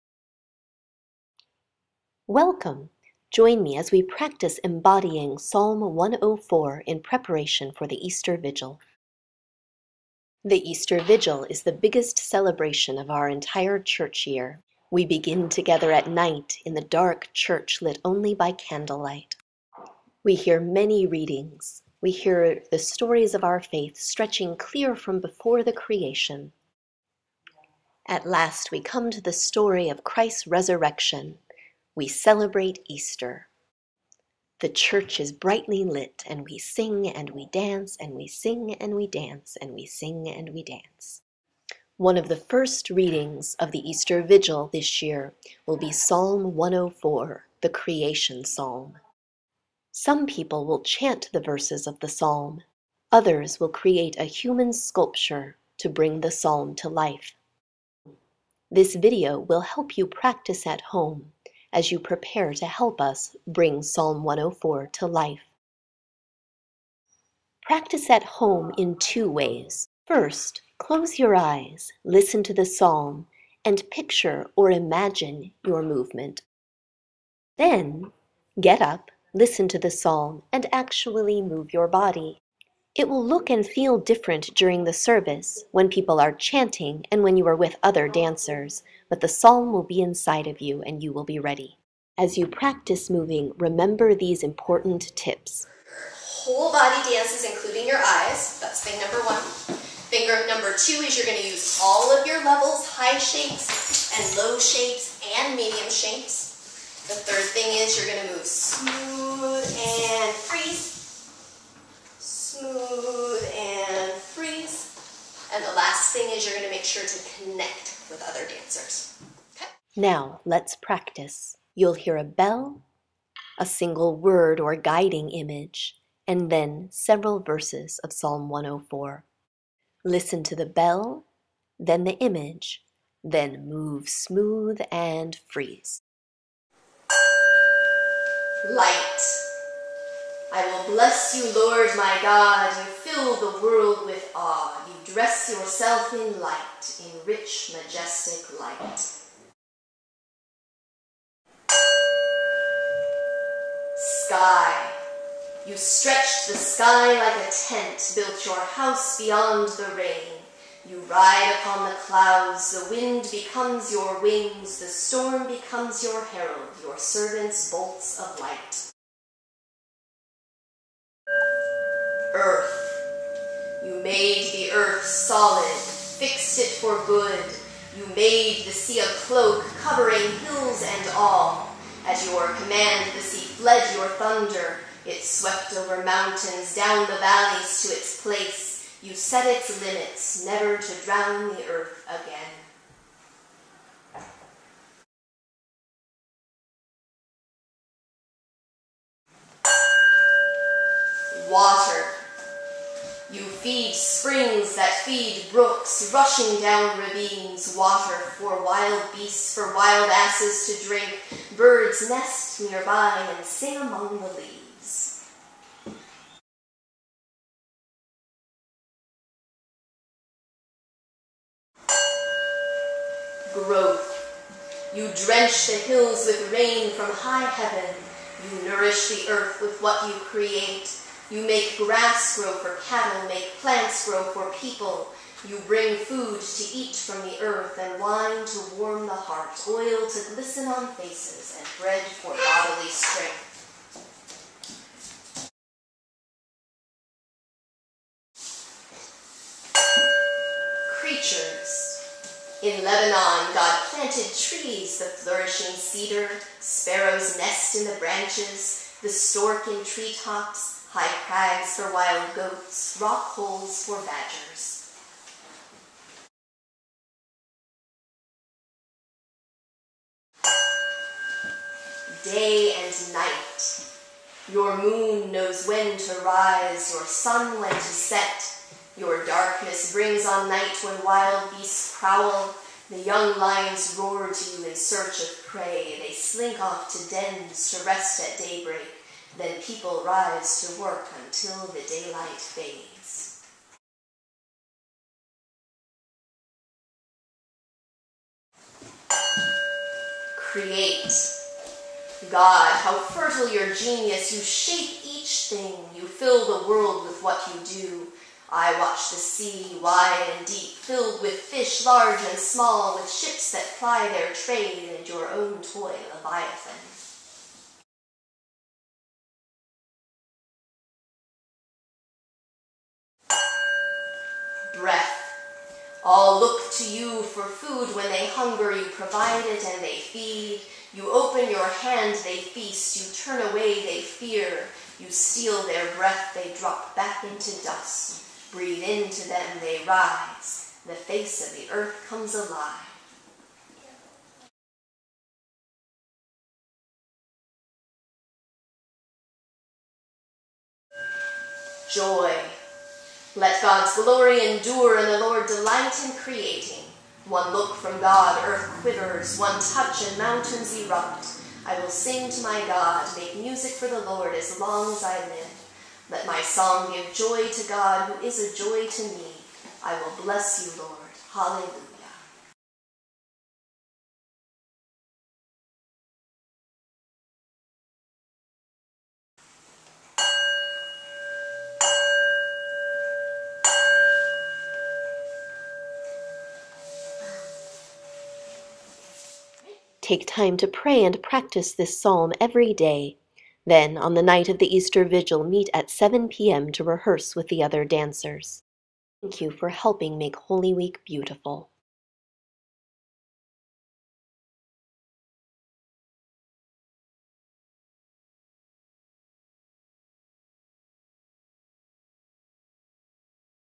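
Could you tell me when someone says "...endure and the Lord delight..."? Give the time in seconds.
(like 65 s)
354 s.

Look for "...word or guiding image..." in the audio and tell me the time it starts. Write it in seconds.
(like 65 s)
124 s.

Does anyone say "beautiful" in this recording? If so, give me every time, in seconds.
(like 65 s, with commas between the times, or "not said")
401 s.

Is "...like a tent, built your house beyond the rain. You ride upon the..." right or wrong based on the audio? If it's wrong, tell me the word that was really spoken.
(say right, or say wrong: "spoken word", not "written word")
right.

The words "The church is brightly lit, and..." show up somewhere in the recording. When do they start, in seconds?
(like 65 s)
34 s.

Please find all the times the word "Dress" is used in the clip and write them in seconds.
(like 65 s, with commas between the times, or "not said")
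145 s.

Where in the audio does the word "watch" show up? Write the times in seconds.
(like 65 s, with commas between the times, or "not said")
308 s.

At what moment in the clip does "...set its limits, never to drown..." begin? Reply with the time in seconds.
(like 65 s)
189 s.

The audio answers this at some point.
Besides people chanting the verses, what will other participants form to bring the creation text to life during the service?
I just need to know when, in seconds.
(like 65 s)
54 s.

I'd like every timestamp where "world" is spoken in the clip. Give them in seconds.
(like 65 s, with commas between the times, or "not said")
143 s, 306 s.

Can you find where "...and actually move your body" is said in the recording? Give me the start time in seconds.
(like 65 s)
80 s.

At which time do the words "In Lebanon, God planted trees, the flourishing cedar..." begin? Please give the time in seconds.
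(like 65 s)
252 s.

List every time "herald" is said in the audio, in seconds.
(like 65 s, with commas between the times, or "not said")
166 s.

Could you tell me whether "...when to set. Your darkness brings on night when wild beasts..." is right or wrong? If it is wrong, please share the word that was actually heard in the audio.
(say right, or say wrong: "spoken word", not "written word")
right.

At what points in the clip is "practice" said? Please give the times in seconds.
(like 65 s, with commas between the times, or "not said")
4 s, 60 s, 67 s, 92 s, 120 s, 391 s.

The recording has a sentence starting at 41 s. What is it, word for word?
One of the first readings of the Easter Vigil this year will be Psalm 104, the Creation Psalm.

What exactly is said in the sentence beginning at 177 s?
You made the sea a cloak, covering hills and all.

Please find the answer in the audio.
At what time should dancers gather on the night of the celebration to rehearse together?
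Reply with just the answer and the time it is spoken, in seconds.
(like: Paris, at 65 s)
7 p.m., at 395 s.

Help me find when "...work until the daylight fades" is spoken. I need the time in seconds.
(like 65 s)
290 s.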